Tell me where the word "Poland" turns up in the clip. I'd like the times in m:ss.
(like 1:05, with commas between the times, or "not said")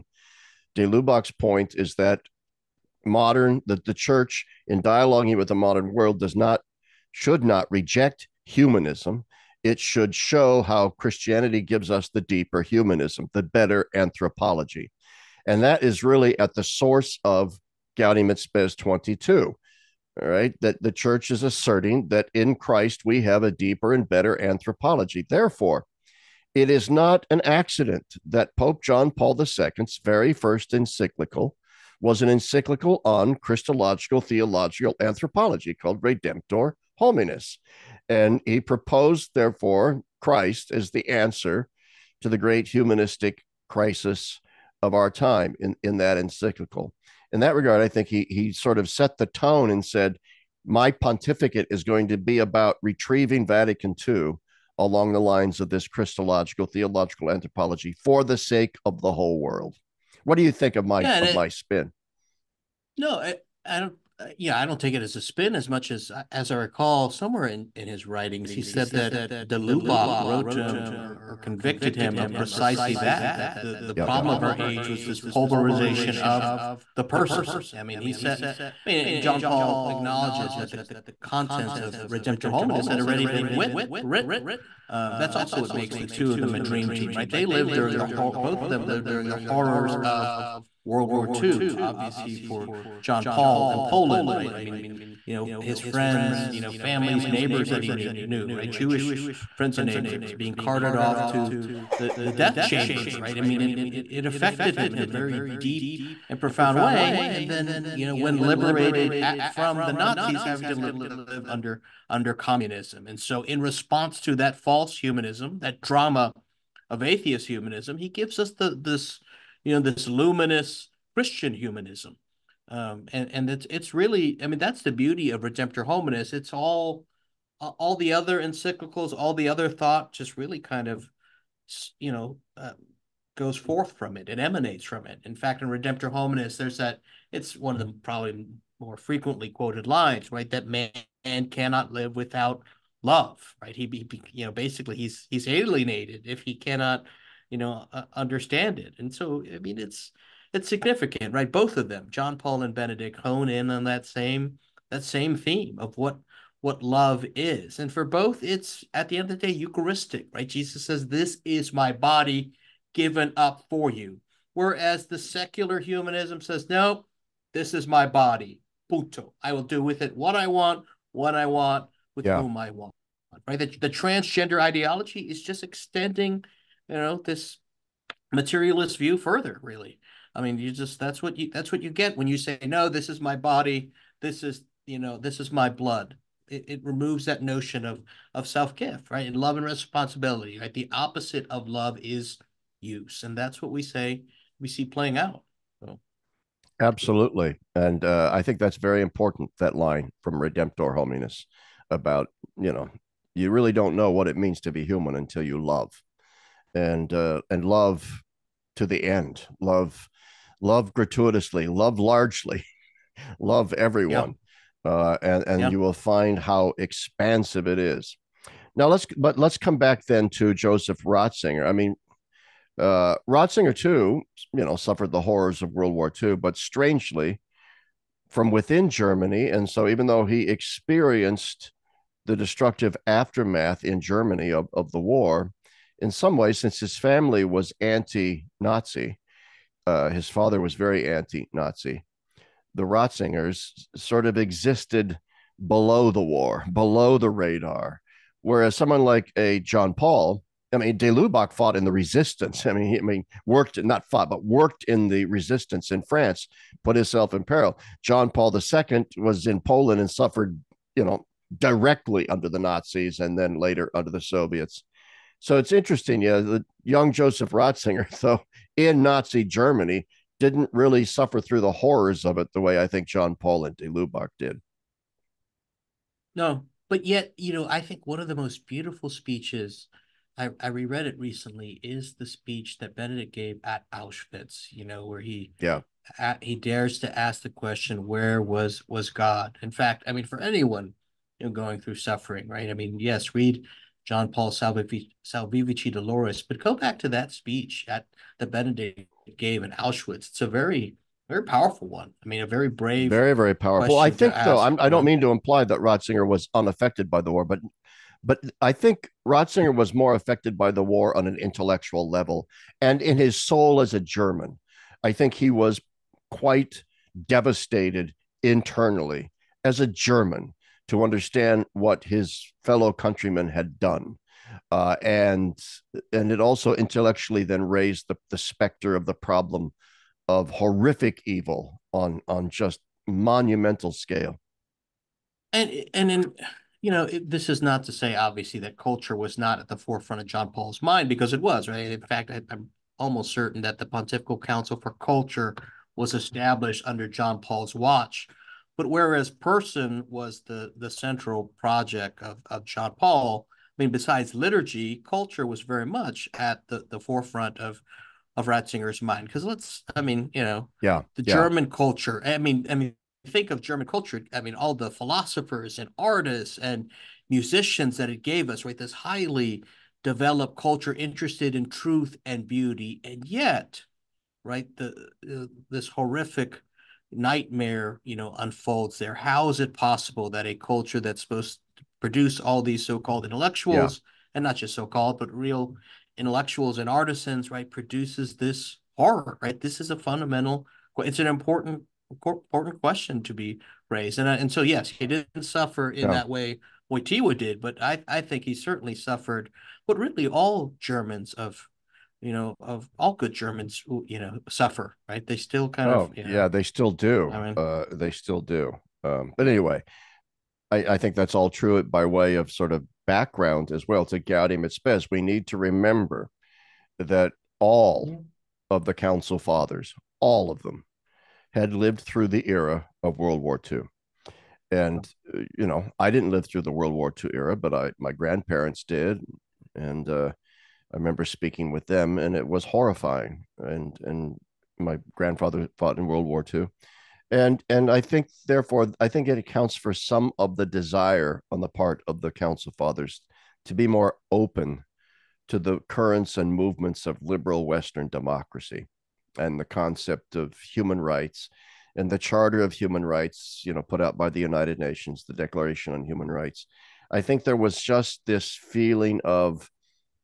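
1:33, 4:19.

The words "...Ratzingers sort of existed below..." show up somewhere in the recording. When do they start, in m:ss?
4:02.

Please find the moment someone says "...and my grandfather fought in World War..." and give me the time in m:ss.
7:14.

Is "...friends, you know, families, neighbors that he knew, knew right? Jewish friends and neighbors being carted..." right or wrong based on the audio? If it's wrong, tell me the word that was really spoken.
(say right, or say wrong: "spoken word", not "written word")
right.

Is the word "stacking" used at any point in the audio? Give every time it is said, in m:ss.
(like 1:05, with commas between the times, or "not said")
not said.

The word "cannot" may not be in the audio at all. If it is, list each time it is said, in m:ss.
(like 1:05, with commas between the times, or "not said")
2:21, 2:26.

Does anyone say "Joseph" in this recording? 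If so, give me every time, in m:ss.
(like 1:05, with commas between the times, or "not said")
3:40, 4:27.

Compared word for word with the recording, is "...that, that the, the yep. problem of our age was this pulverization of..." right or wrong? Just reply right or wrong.
right.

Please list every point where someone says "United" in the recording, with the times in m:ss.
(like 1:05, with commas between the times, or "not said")
7:34.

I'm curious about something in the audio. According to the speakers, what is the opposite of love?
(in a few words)
use.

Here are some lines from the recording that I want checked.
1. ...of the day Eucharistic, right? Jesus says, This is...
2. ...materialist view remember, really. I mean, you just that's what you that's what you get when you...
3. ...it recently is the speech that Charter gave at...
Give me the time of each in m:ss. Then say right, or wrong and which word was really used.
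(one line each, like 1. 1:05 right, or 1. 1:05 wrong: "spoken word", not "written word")
1. 2:39 right
2. 2:58 wrong: "further", not "remember"
3. 4:41 wrong: "Benedict", not "Charter".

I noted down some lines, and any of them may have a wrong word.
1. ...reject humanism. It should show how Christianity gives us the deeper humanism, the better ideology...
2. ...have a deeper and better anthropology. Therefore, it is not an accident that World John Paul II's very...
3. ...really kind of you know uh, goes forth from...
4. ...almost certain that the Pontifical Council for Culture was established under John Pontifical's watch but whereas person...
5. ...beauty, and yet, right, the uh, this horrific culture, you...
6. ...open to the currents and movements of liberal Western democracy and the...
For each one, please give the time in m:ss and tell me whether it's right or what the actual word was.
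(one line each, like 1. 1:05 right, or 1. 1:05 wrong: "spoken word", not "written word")
1. 0:07 wrong: "anthropology", not "ideology"
2. 0:23 wrong: "Pope", not "World"
3. 2:10 right
4. 5:42 wrong: "Paul", not "Pontifical"
5. 6:12 wrong: "nightmare", not "culture"
6. 7:24 right.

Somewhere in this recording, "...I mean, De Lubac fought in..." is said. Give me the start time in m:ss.
4:10.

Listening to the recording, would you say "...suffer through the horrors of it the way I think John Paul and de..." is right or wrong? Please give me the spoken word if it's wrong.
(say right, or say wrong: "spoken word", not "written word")
right.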